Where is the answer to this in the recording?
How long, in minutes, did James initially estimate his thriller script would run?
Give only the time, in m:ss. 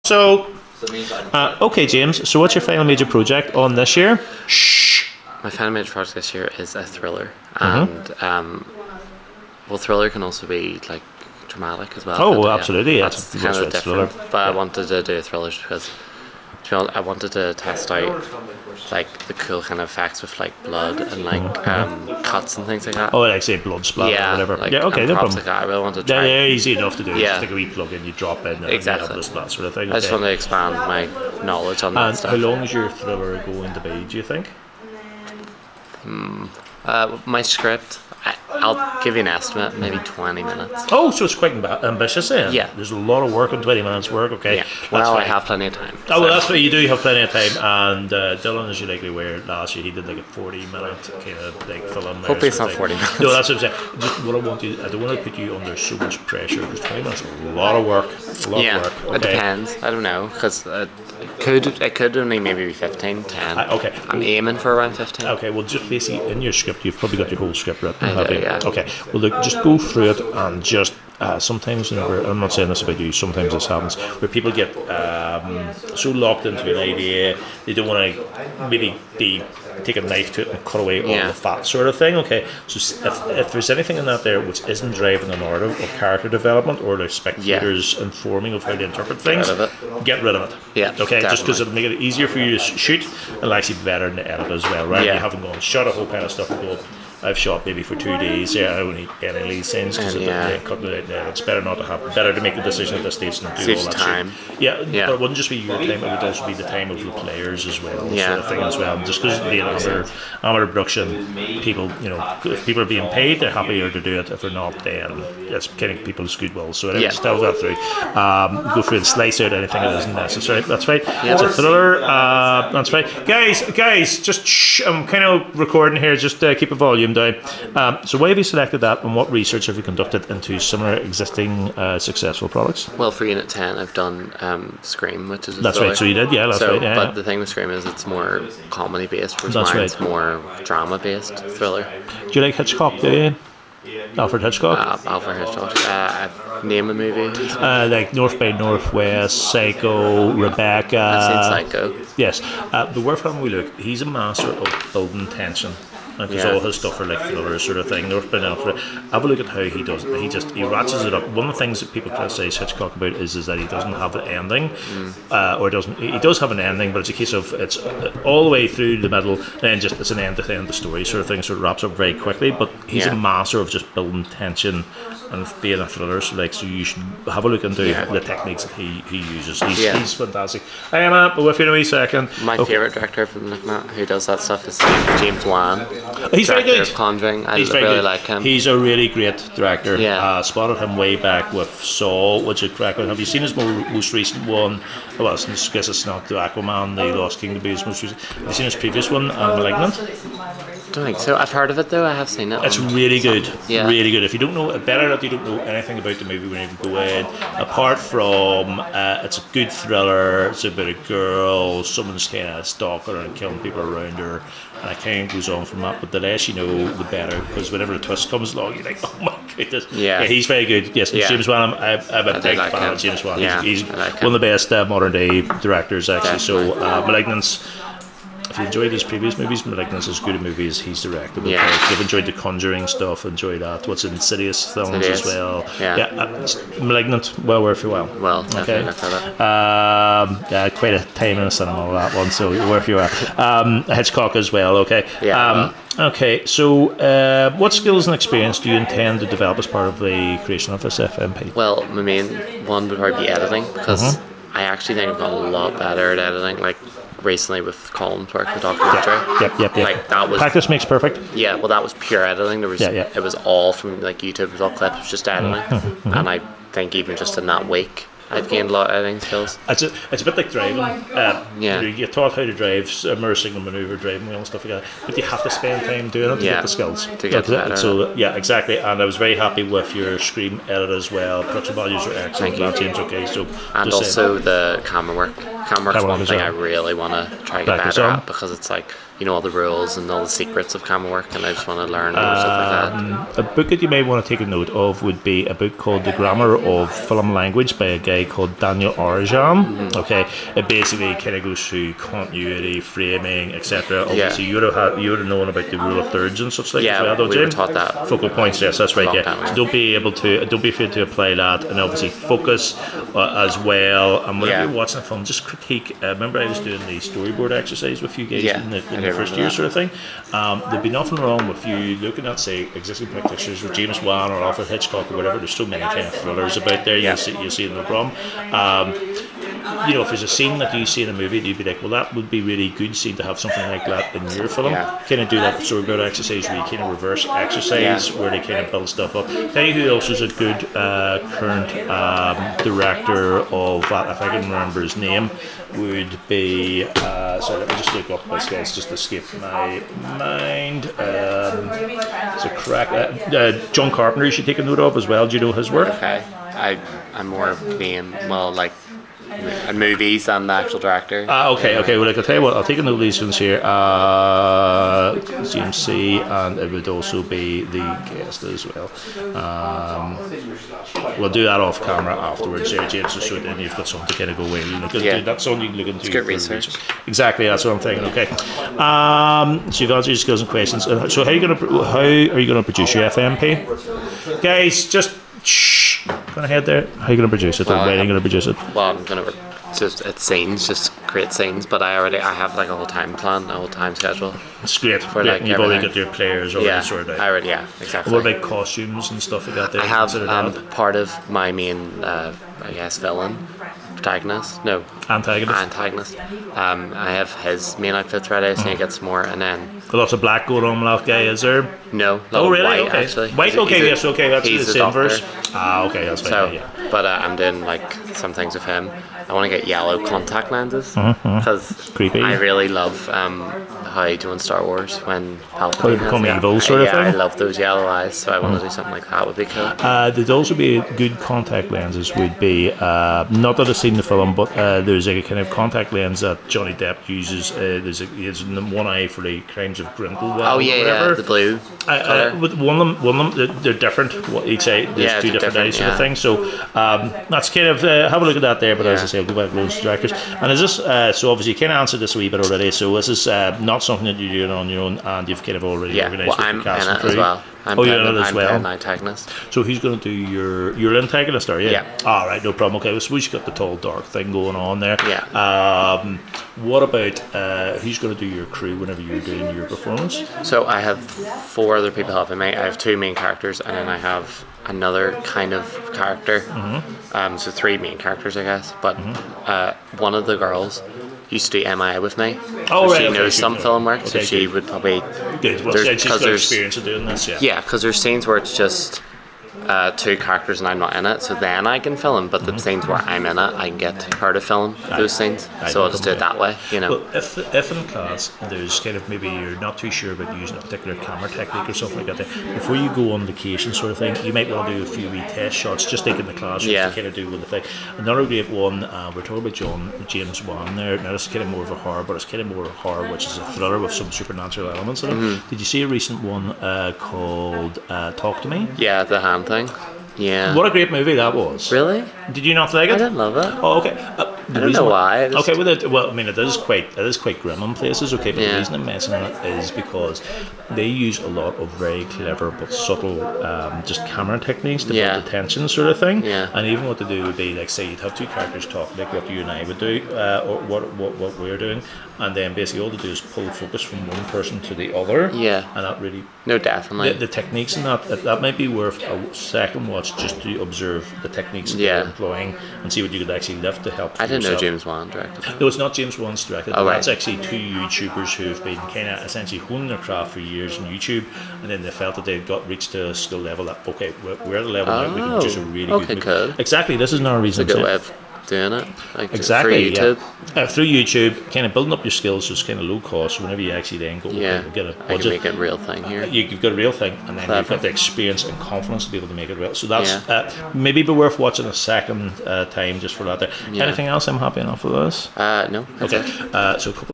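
0:39.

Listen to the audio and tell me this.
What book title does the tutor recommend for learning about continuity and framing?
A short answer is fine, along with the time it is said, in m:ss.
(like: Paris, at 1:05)
The Grammar of Film Language, at 4:56.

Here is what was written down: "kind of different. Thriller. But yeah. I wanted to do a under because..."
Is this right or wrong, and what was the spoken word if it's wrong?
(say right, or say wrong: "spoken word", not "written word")
wrong: "thriller", not "under".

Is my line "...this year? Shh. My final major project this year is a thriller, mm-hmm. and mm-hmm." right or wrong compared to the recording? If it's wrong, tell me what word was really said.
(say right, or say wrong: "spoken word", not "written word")
right.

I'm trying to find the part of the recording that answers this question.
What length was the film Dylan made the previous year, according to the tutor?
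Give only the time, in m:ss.
0:50.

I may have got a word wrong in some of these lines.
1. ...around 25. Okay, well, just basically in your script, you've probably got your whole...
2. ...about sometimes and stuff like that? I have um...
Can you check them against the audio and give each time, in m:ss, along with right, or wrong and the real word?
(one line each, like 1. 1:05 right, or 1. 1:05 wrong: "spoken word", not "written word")
1. 1:04 wrong: "15", not "25"
2. 6:38 wrong: "costumes", not "sometimes".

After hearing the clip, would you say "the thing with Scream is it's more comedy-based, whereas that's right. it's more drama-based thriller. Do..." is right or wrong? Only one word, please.
right.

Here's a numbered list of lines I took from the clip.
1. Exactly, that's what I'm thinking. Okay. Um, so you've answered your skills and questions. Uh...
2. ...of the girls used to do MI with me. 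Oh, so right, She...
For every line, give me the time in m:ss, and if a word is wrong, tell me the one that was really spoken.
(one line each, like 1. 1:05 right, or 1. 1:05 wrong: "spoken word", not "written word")
1. 6:17 right
2. 8:00 right.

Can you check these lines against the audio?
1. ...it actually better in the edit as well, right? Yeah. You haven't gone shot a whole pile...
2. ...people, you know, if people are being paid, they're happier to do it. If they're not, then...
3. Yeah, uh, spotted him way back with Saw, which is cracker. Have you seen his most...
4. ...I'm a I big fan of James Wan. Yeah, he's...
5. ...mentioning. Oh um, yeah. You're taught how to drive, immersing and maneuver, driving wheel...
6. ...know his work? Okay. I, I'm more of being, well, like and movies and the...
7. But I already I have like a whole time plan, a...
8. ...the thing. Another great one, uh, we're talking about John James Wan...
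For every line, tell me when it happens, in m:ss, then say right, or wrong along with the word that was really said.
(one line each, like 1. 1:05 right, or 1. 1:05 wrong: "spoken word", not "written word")
1. 1:33 right
2. 1:51 right
3. 3:09 right
4. 3:41 right
5. 4:30 wrong: "driving", not "mentioning"
6. 5:55 right
7. 6:31 right
8. 8:27 right.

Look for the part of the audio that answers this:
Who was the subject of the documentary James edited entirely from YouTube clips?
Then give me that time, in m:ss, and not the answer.
4:17.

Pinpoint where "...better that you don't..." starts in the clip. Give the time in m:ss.
3:24.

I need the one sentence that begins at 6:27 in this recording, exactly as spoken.
Well, the way gonna produce it?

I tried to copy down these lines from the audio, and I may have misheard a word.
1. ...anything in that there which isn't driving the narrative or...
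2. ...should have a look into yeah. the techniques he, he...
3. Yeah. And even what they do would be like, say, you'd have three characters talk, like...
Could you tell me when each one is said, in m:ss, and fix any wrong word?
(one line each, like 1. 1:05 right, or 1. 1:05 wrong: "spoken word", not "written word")
1. 1:23 right
2. 2:56 right
3. 8:56 wrong: "two", not "three".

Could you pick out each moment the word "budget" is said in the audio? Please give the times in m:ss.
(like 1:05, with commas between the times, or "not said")
9:34.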